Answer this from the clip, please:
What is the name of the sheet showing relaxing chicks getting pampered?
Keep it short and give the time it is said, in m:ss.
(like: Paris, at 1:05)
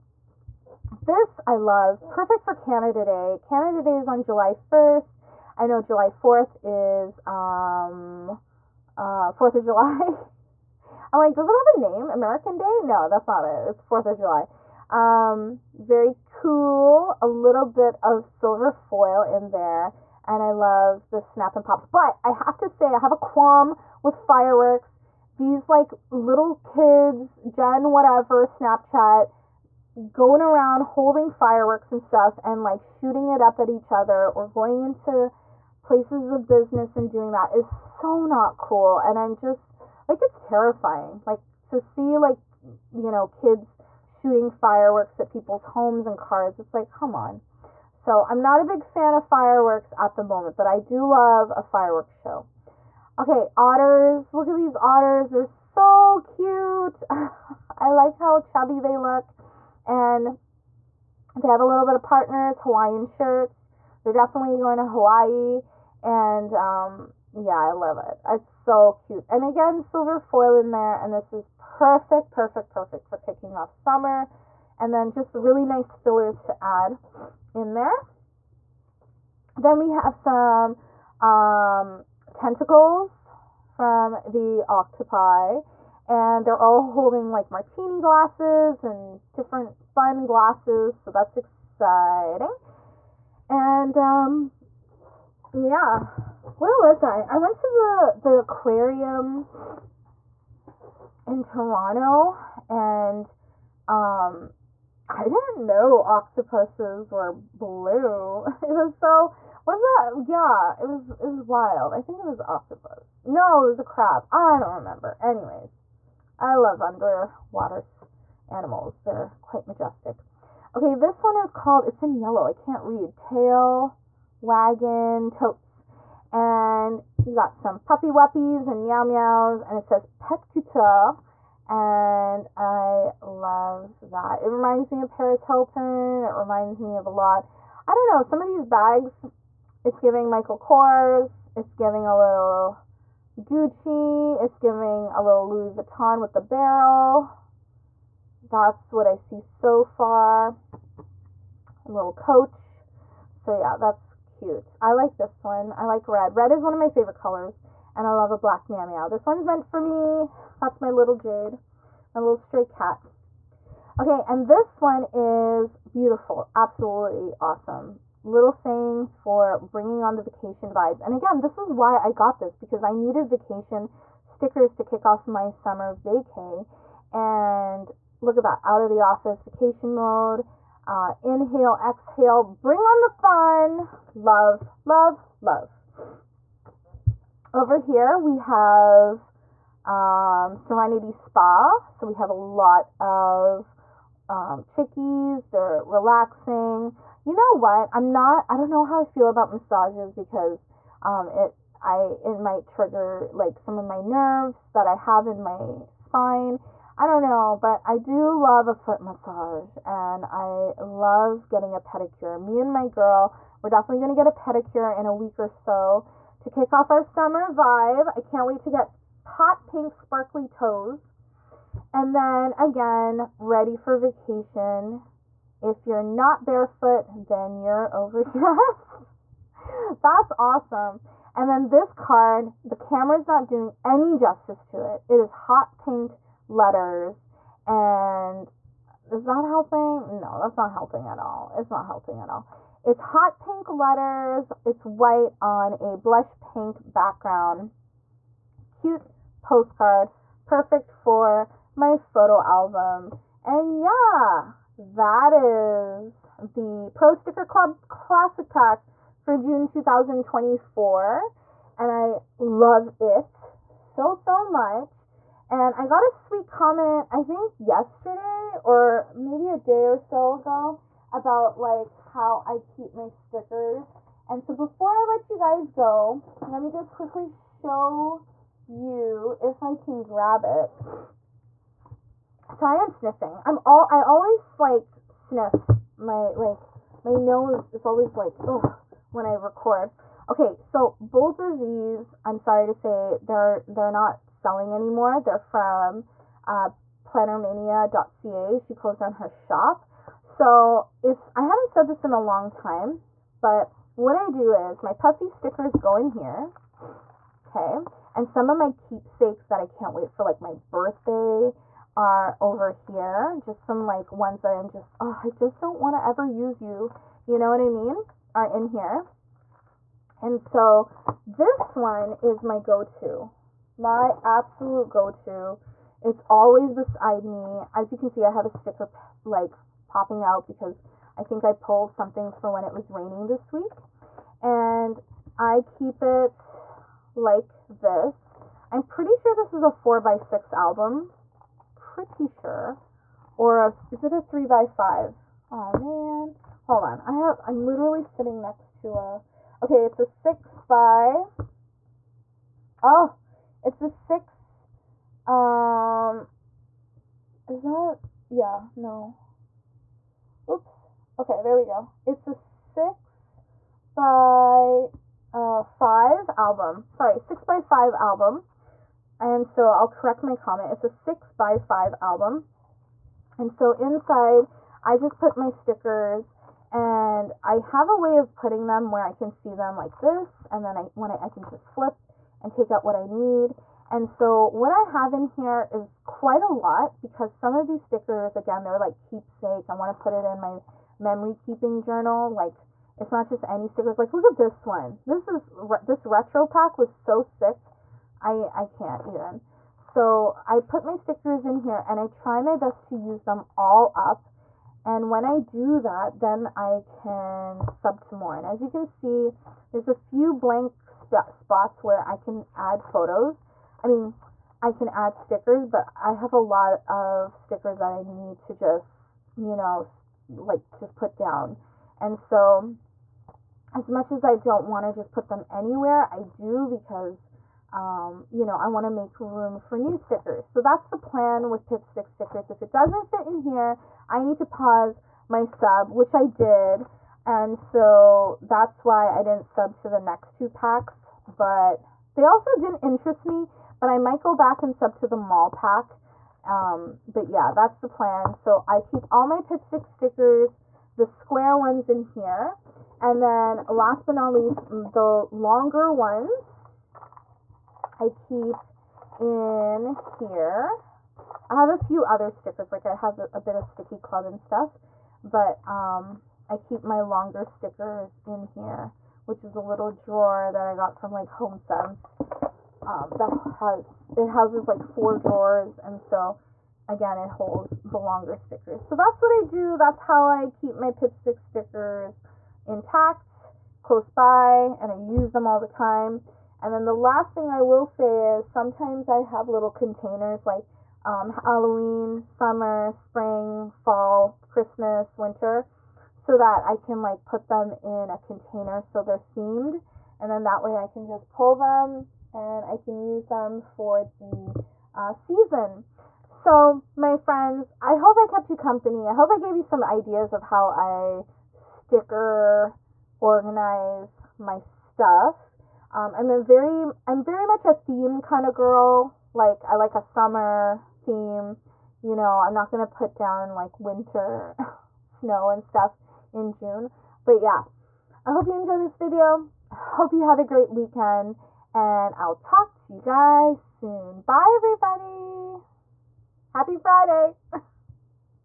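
Serenity Spa, at 3:10.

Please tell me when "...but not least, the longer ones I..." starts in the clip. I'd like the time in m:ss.
7:34.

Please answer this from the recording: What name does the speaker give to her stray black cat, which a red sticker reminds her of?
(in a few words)
Jade.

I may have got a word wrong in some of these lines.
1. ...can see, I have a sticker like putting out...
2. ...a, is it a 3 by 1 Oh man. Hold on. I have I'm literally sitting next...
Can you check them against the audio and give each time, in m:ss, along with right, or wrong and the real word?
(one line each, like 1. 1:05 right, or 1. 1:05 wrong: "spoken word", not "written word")
1. 5:27 wrong: "popping", not "putting"
2. 5:43 wrong: "5", not "1".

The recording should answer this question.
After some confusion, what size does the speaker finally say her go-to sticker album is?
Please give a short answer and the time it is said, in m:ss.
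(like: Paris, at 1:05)
6 by 5, at 6:02.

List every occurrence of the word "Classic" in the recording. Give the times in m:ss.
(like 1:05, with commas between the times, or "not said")
4:17.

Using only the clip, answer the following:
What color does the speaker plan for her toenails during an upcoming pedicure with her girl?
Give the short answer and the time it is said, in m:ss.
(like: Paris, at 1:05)
hot pink sparkly, at 3:39.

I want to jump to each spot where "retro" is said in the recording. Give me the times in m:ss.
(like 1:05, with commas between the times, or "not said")
6:36.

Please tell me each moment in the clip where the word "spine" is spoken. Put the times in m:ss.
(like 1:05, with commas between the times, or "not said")
3:25.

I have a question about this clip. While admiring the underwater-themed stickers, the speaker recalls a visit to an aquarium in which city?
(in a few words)
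Toronto.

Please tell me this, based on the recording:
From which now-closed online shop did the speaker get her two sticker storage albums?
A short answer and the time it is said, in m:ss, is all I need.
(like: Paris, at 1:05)
plannermania.ca, at 4:57.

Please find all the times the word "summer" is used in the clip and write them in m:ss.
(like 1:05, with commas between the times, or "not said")
1:13, 2:55, 3:37, 8:12, 8:40.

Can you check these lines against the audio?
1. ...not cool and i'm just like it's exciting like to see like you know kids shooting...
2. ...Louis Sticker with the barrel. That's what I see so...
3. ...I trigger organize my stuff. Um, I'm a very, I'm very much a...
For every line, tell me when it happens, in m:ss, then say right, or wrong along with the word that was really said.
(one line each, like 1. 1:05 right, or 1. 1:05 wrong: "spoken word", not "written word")
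1. 0:38 wrong: "terrifying", not "exciting"
2. 2:25 wrong: "Vuitton", not "Sticker"
3. 8:30 wrong: "sticker", not "trigger".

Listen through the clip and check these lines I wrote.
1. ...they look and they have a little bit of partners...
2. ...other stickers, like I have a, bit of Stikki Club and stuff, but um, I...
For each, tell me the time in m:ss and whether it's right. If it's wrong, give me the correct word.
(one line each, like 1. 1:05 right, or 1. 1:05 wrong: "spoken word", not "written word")
1. 0:58 right
2. 7:42 right.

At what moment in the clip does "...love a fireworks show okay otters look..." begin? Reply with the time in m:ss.
0:51.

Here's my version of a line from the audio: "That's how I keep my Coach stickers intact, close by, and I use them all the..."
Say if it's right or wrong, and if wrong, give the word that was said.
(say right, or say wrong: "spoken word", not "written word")
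wrong: "Pipstick", not "Coach".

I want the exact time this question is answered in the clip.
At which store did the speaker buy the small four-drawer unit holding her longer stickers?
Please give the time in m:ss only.
7:51.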